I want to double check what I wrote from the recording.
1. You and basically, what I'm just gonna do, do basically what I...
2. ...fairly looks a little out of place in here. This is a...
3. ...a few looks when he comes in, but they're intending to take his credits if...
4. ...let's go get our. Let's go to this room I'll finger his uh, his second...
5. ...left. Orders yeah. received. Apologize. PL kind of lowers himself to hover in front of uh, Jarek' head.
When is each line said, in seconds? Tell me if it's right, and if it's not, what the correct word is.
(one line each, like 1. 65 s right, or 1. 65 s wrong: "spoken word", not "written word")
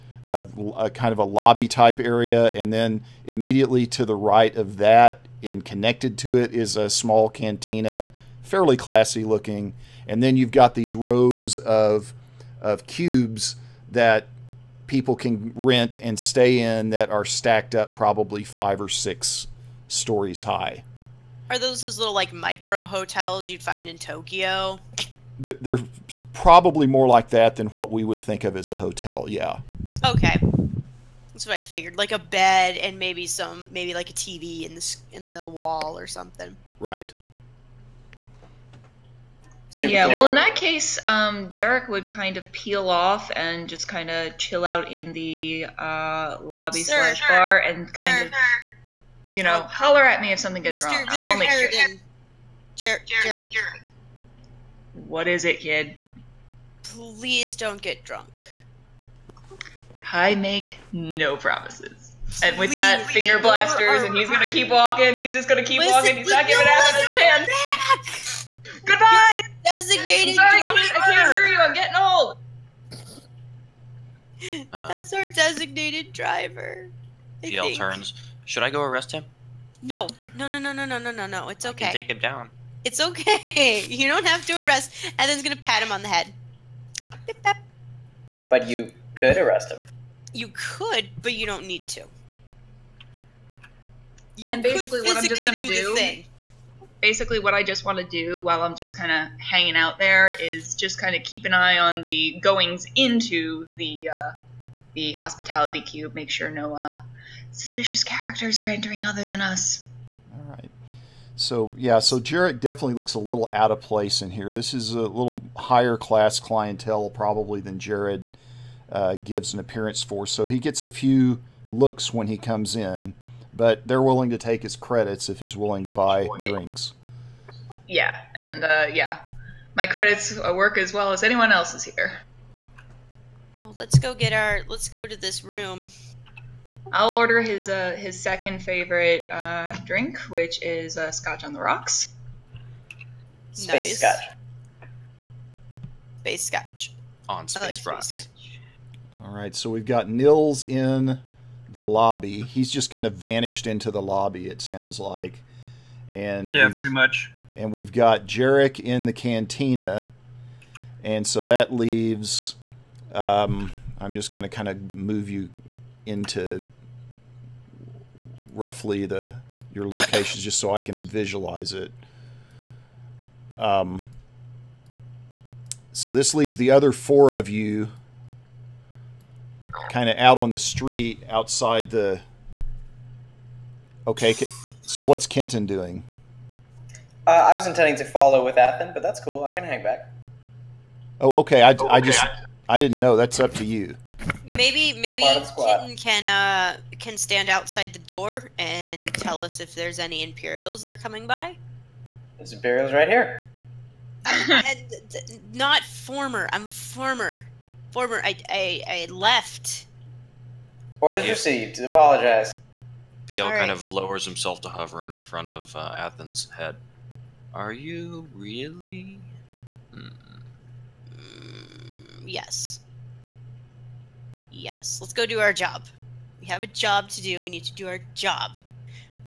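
1. 94 s right
2. 112 s wrong: "definitely", not "fairly"
3. 120 s wrong: "willing", not "intending"
4. 133 s wrong: "order", not "finger"
5. 209 s wrong: "Athens", not "Jarek".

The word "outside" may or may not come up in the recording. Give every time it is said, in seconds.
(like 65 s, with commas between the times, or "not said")
181 s, 197 s.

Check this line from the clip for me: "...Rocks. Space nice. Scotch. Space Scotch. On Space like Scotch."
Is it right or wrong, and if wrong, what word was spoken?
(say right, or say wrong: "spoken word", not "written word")
wrong: "Rocks", not "Scotch".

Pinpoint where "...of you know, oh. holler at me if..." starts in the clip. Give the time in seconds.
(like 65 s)
48 s.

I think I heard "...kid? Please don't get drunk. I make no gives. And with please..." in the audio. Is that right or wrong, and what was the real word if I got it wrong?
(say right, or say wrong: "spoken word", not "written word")
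wrong: "promises", not "gives".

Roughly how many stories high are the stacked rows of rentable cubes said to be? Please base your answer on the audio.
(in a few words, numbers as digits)
5 or 6.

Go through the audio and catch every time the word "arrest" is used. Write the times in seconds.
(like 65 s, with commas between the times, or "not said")
78 s, 84 s, 89 s.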